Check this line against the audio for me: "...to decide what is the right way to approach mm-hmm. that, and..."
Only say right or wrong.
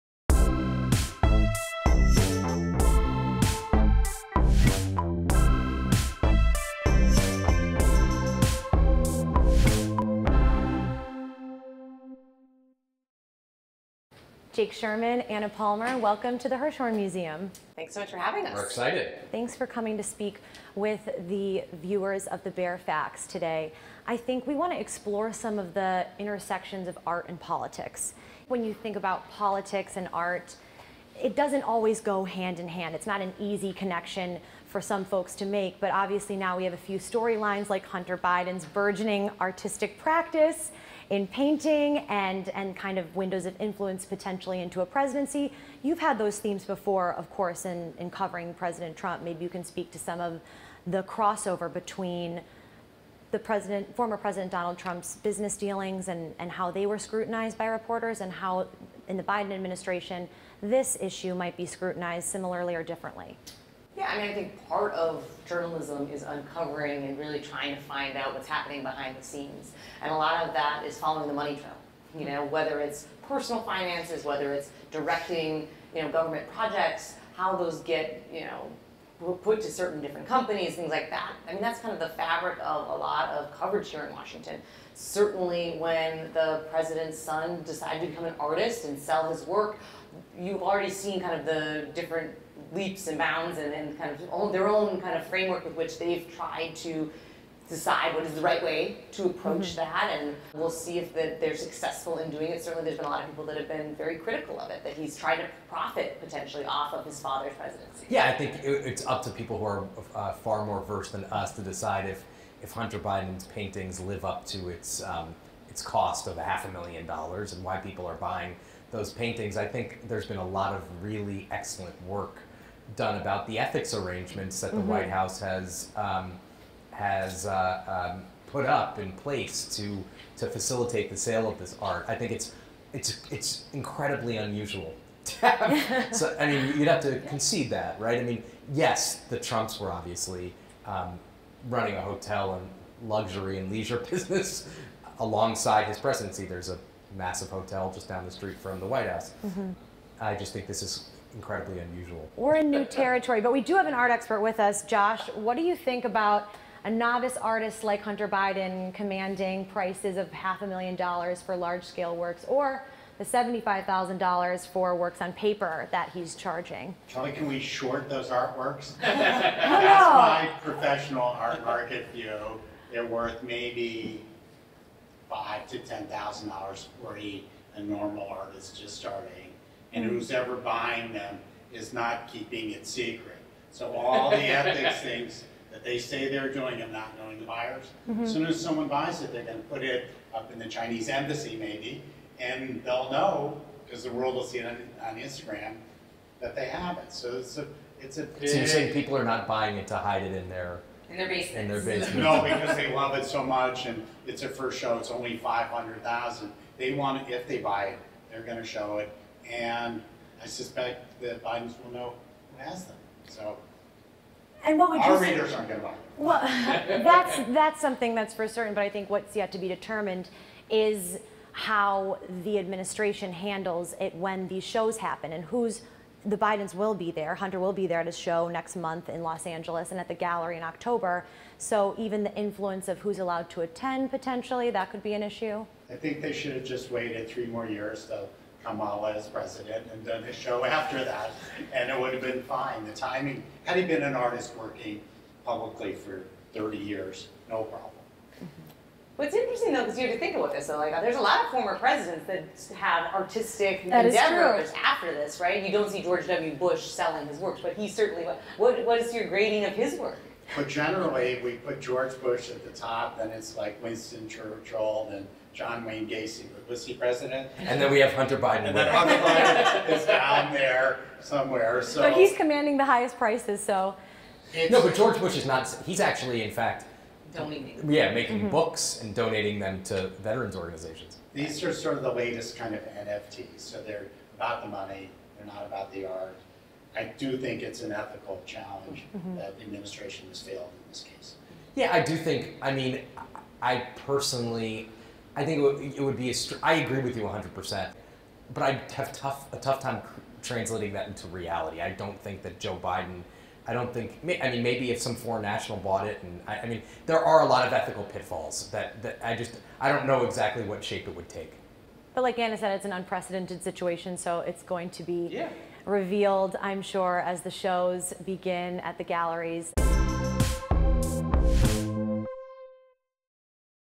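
right.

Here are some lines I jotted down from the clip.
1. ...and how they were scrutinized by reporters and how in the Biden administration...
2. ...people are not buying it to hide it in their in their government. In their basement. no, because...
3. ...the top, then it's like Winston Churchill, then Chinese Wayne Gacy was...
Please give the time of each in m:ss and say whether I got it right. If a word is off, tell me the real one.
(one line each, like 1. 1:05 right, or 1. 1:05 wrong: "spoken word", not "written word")
1. 0:56 right
2. 3:18 wrong: "basement", not "government"
3. 4:22 wrong: "John", not "Chinese".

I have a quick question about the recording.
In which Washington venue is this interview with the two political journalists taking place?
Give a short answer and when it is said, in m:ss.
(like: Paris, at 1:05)
Hirshhorn Museum, at 0:16.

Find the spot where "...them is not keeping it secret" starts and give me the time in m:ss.
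3:01.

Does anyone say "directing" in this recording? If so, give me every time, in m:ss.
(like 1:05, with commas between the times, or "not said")
1:14.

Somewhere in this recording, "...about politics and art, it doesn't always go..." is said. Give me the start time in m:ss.
0:28.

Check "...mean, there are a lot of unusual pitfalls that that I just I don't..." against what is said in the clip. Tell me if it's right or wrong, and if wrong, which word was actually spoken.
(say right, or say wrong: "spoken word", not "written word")
wrong: "ethical", not "unusual".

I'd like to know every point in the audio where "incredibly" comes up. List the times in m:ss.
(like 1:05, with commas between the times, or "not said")
2:13, 2:31.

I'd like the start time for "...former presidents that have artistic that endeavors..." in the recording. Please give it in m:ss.
4:11.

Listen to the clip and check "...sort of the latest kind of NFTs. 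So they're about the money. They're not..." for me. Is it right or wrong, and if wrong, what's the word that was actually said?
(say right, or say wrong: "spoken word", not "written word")
right.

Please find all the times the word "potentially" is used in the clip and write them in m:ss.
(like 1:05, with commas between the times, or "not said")
0:44, 1:46, 3:54.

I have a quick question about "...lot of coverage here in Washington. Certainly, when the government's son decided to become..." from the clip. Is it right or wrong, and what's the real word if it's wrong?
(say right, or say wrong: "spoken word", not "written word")
wrong: "president", not "government".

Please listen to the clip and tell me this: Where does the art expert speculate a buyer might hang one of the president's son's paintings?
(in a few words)
the Chinese embassy.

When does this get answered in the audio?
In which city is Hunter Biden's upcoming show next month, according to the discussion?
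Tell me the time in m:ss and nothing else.
3:49.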